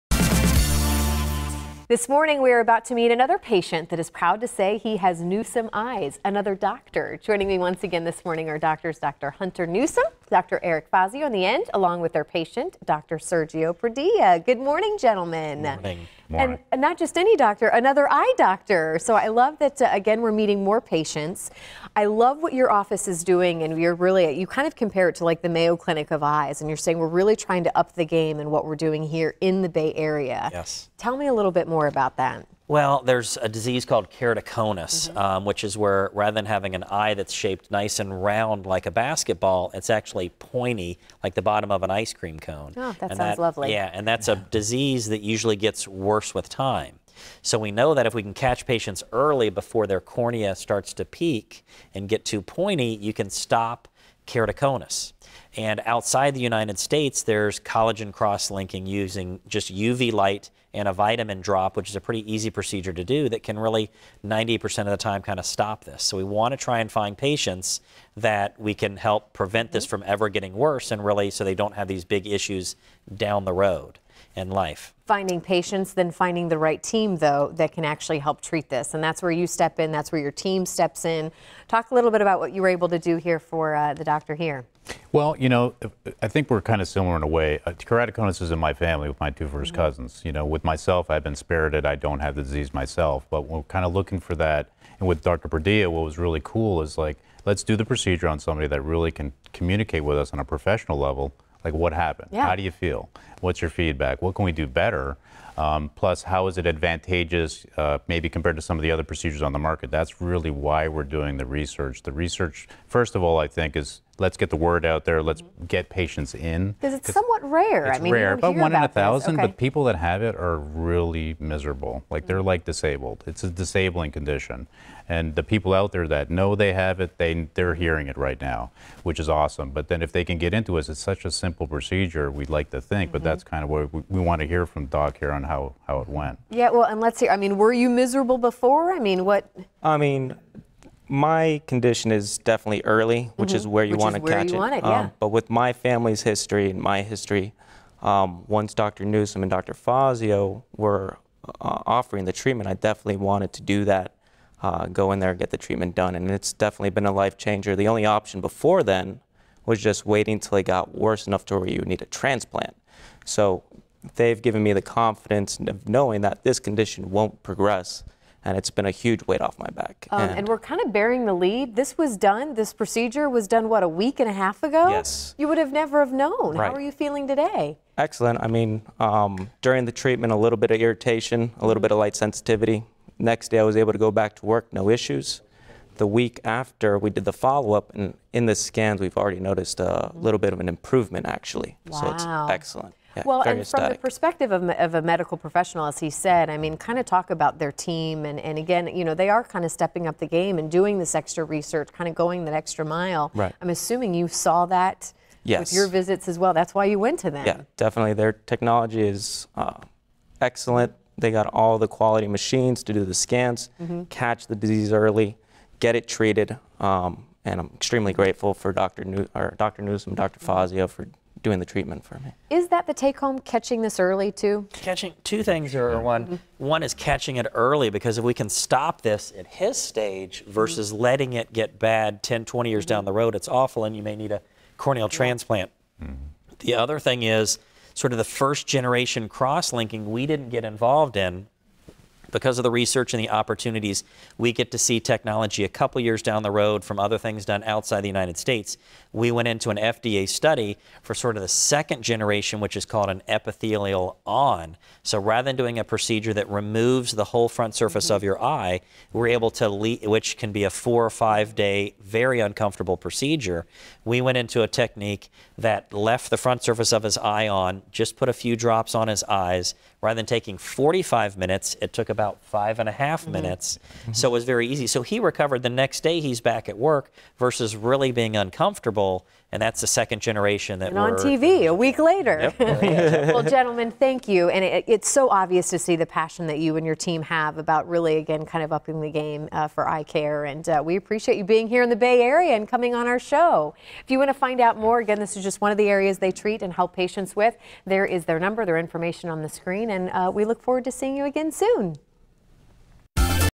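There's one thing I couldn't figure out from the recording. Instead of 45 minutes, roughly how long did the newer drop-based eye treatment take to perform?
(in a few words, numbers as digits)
5.5 minutes.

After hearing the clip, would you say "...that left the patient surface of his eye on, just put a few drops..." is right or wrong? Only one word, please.
wrong.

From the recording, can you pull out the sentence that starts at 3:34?
catch the disease early, get it treated.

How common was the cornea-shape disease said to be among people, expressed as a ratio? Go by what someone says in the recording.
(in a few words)
1 in 1,000.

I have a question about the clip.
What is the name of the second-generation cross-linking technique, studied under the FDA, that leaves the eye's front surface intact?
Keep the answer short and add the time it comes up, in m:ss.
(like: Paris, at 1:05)
epithelial on, at 4:13.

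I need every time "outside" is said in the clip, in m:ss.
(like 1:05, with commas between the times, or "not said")
0:55, 4:07.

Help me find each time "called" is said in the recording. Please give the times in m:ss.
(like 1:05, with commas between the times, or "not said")
0:33, 4:12.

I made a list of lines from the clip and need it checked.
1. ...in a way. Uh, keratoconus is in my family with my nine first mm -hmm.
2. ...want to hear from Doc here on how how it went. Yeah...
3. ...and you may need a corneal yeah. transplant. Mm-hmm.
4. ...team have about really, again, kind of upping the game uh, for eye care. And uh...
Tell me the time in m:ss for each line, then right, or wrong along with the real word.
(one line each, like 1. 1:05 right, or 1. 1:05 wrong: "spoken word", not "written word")
1. 1:27 wrong: "two", not "nine"
2. 2:14 right
3. 3:53 right
4. 4:46 right.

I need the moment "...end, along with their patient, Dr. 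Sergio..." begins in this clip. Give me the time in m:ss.
0:11.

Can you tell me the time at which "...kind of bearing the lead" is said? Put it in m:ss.
2:50.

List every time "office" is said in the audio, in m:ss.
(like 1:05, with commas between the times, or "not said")
0:22.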